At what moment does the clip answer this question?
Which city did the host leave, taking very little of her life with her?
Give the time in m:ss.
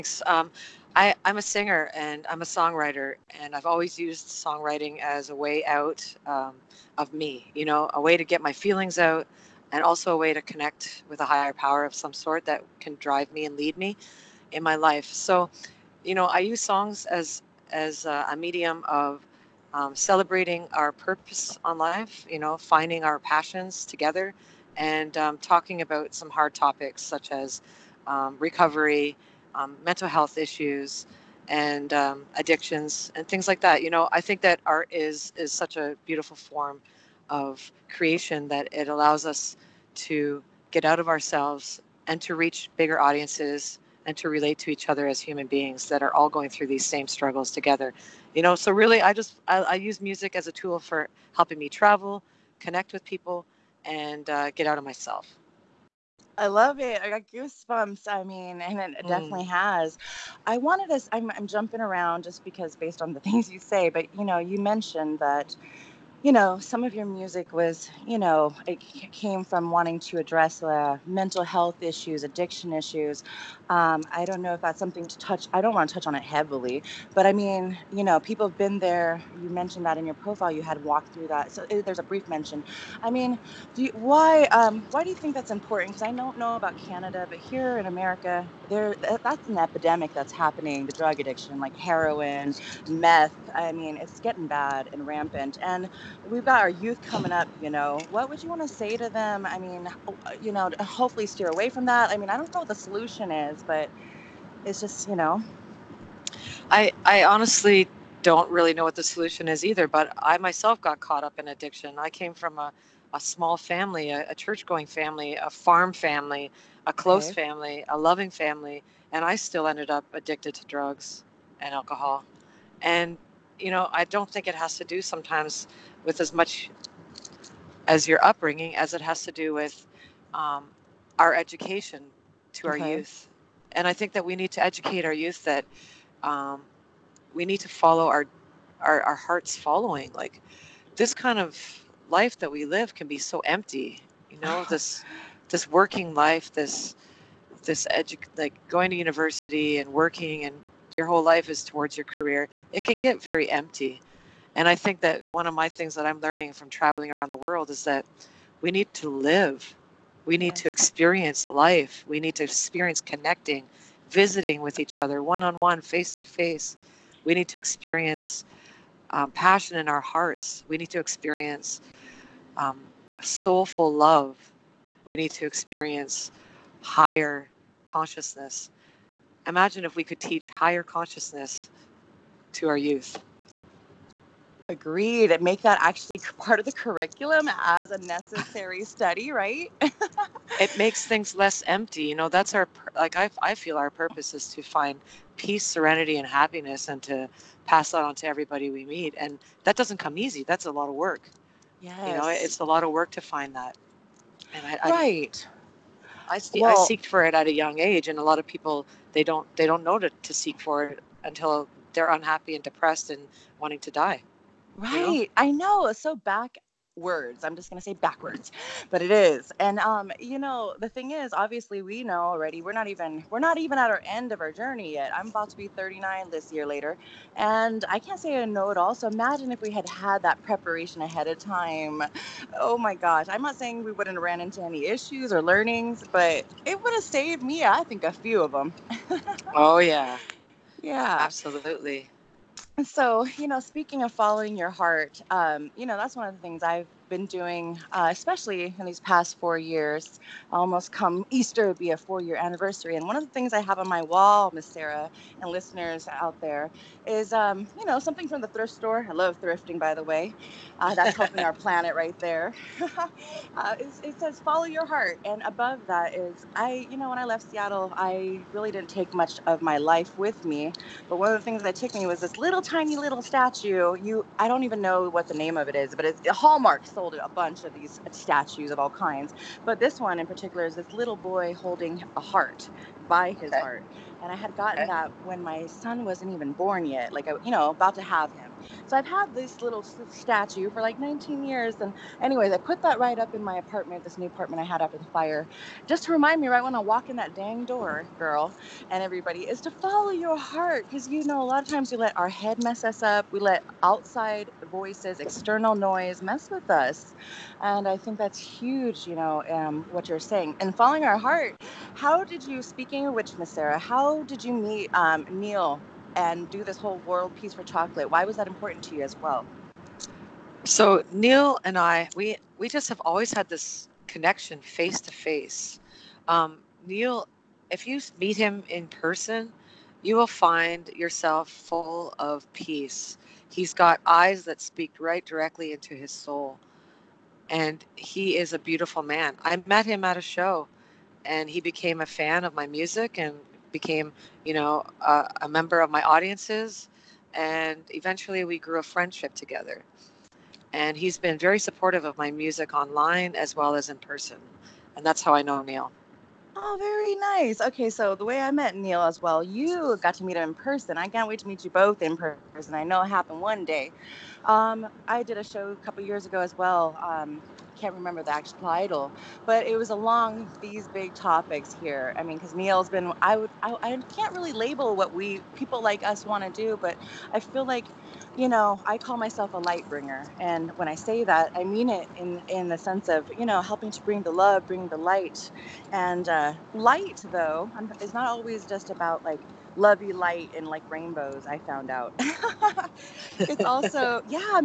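4:27.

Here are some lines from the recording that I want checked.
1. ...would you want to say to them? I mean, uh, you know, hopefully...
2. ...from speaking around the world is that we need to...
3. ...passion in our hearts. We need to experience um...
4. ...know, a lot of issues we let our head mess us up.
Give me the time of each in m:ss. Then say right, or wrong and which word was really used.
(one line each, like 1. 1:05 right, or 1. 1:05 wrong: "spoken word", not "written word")
1. 1:38 right
2. 2:36 wrong: "traveling", not "speaking"
3. 2:49 right
4. 5:01 wrong: "times", not "issues".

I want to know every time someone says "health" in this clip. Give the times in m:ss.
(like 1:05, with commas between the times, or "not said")
0:30, 1:11.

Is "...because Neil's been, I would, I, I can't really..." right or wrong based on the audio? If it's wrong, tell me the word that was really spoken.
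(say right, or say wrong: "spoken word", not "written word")
right.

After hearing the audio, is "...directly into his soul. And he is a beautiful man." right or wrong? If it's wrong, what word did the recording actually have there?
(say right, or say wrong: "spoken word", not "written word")
right.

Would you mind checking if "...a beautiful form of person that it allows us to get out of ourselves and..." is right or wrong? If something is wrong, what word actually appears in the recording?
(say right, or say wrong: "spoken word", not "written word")
wrong: "creation", not "person".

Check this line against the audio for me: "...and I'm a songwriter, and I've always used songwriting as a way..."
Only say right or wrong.
right.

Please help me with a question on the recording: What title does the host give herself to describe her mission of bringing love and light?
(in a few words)
light bringer.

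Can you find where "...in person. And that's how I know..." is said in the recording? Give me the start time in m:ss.
5:53.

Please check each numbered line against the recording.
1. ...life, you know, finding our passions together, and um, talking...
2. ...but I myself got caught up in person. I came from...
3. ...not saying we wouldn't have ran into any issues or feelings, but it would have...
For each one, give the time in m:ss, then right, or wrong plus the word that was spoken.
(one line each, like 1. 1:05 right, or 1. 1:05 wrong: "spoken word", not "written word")
1. 0:21 right
2. 1:49 wrong: "addiction", not "person"
3. 3:53 wrong: "learnings", not "feelings".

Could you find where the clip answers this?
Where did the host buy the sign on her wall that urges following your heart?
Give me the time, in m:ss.
4:18.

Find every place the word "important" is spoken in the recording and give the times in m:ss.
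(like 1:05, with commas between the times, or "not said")
1:25, 5:18.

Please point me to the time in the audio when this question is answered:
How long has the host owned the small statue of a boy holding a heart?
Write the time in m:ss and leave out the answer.
4:50.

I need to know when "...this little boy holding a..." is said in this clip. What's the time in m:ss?
4:40.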